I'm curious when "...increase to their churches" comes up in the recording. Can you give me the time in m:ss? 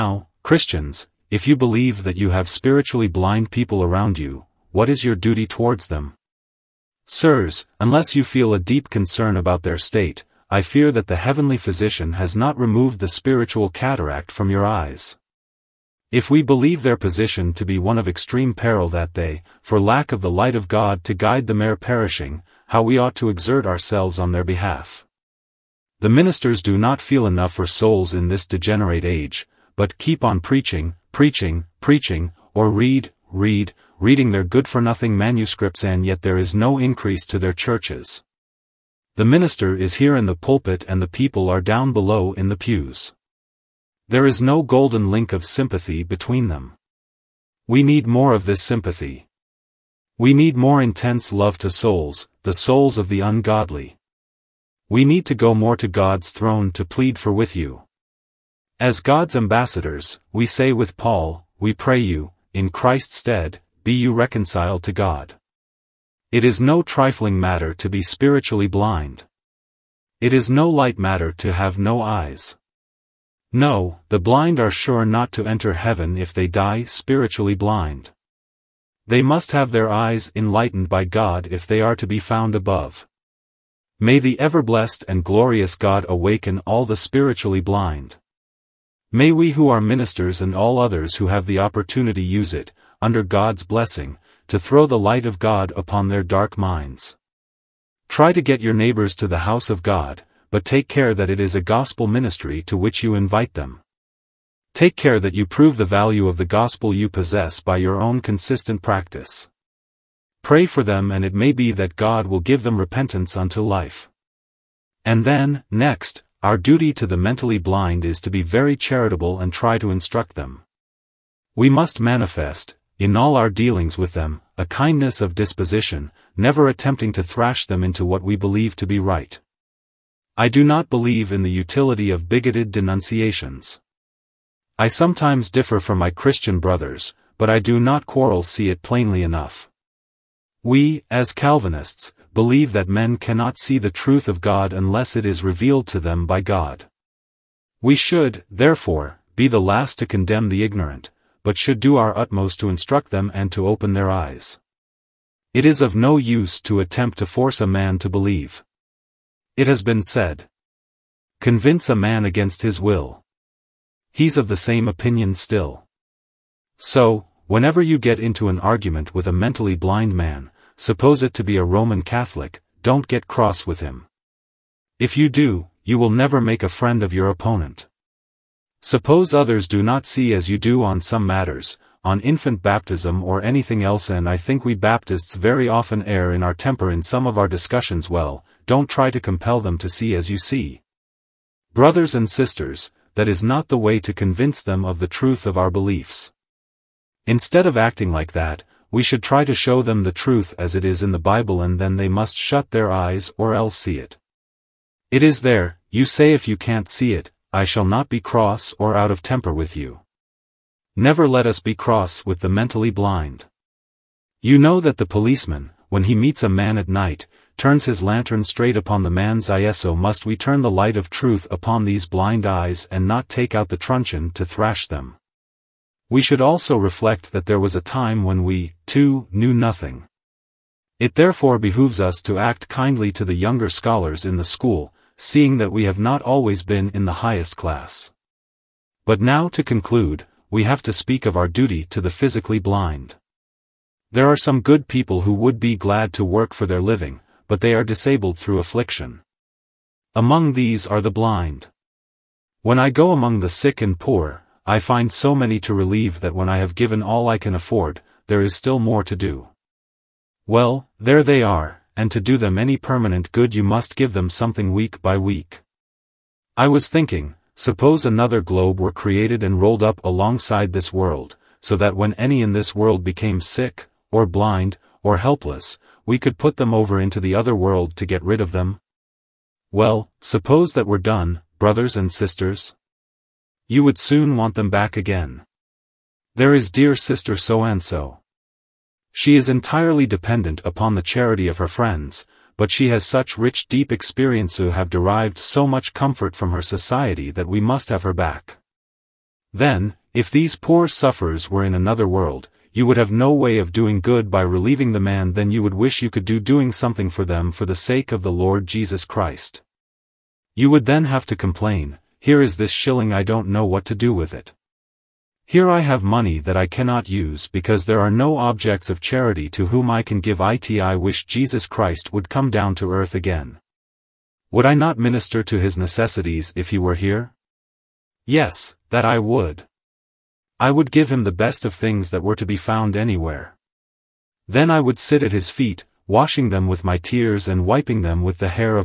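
0:36.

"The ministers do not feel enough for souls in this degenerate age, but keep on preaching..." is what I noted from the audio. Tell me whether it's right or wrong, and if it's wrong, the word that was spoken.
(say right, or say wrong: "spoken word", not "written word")
right.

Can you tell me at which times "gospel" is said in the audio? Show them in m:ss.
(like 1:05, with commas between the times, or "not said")
1:41, 1:46.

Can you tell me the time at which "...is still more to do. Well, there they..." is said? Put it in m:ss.
4:18.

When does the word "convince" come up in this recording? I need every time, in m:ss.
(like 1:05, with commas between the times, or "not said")
2:41, 3:14.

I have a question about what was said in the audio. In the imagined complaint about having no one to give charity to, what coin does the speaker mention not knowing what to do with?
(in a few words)
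shilling.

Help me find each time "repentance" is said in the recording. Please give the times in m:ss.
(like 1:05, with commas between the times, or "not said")
1:52.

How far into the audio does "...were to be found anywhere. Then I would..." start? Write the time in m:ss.
5:32.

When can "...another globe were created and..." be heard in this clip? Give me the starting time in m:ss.
4:28.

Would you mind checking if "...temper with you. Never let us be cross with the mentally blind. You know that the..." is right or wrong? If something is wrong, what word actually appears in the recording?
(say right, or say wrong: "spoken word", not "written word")
right.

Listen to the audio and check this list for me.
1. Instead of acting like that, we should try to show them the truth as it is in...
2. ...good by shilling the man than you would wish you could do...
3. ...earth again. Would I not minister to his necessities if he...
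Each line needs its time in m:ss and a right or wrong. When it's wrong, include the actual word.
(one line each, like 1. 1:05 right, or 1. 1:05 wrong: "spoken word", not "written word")
1. 3:17 right
2. 5:04 wrong: "relieving", not "shilling"
3. 5:22 right.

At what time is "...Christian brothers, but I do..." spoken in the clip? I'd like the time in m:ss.
2:16.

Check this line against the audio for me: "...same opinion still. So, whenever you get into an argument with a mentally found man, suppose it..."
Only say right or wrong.
wrong.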